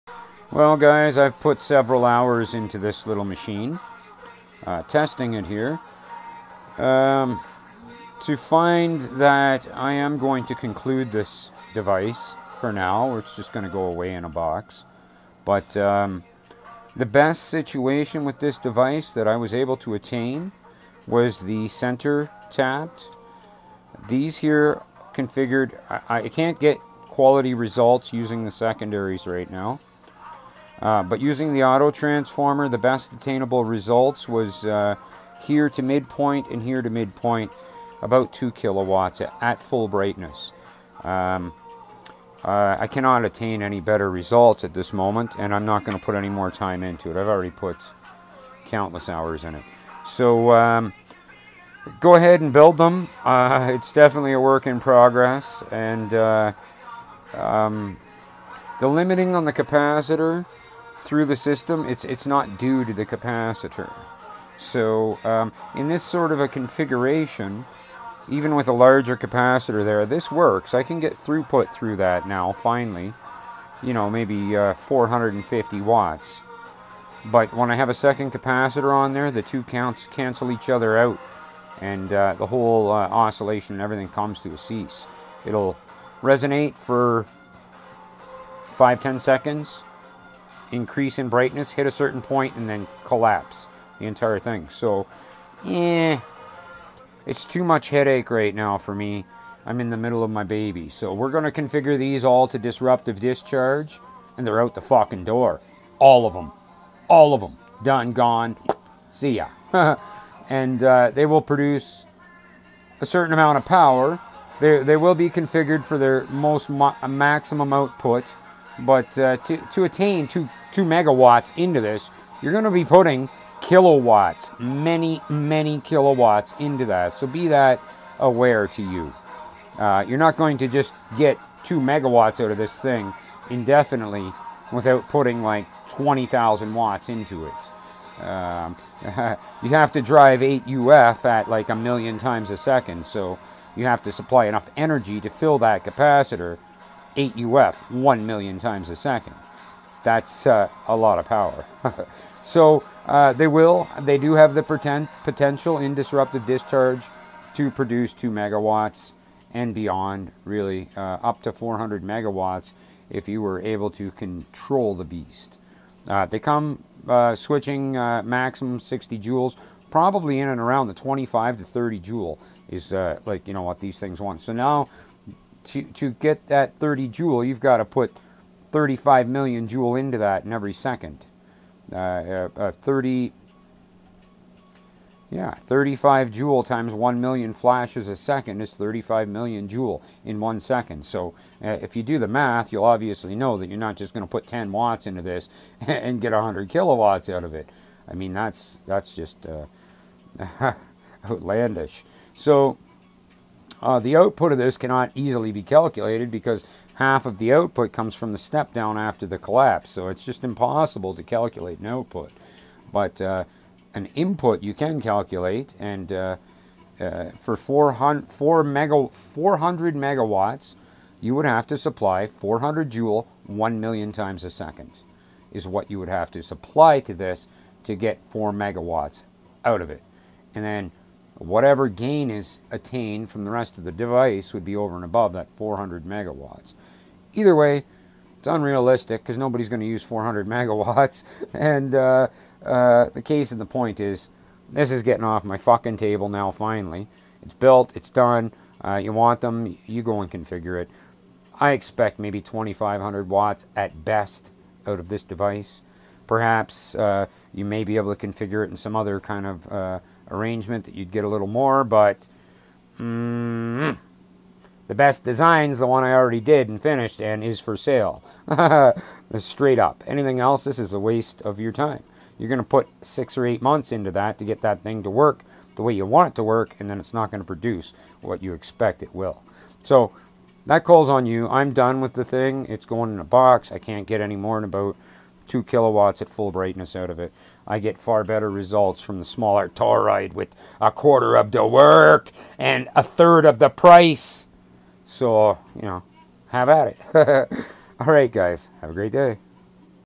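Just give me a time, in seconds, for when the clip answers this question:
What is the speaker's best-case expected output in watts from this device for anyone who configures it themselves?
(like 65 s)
252 s.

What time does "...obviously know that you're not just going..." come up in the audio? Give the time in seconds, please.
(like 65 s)
192 s.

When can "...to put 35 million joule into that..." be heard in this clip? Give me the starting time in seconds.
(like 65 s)
177 s.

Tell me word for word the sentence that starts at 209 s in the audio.
So it's just impossible to calculate an output.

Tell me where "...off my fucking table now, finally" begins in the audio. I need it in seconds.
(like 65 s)
245 s.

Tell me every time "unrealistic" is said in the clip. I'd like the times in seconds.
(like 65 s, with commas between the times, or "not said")
238 s.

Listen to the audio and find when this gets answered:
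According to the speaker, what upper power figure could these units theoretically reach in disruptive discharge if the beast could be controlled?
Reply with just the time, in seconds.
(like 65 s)
161 s.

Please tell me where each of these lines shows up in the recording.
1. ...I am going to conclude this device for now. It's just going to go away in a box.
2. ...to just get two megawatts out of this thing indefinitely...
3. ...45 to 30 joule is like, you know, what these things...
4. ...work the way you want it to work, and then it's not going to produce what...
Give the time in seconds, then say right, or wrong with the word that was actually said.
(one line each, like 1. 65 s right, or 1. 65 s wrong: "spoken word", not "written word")
1. 9 s right
2. 130 s right
3. 170 s wrong: "25", not "45"
4. 275 s right.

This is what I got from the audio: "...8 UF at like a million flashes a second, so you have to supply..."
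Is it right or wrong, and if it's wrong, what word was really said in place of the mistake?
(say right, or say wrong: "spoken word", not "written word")
wrong: "times", not "flashes".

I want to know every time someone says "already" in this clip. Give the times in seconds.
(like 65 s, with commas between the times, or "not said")
47 s, 266 s.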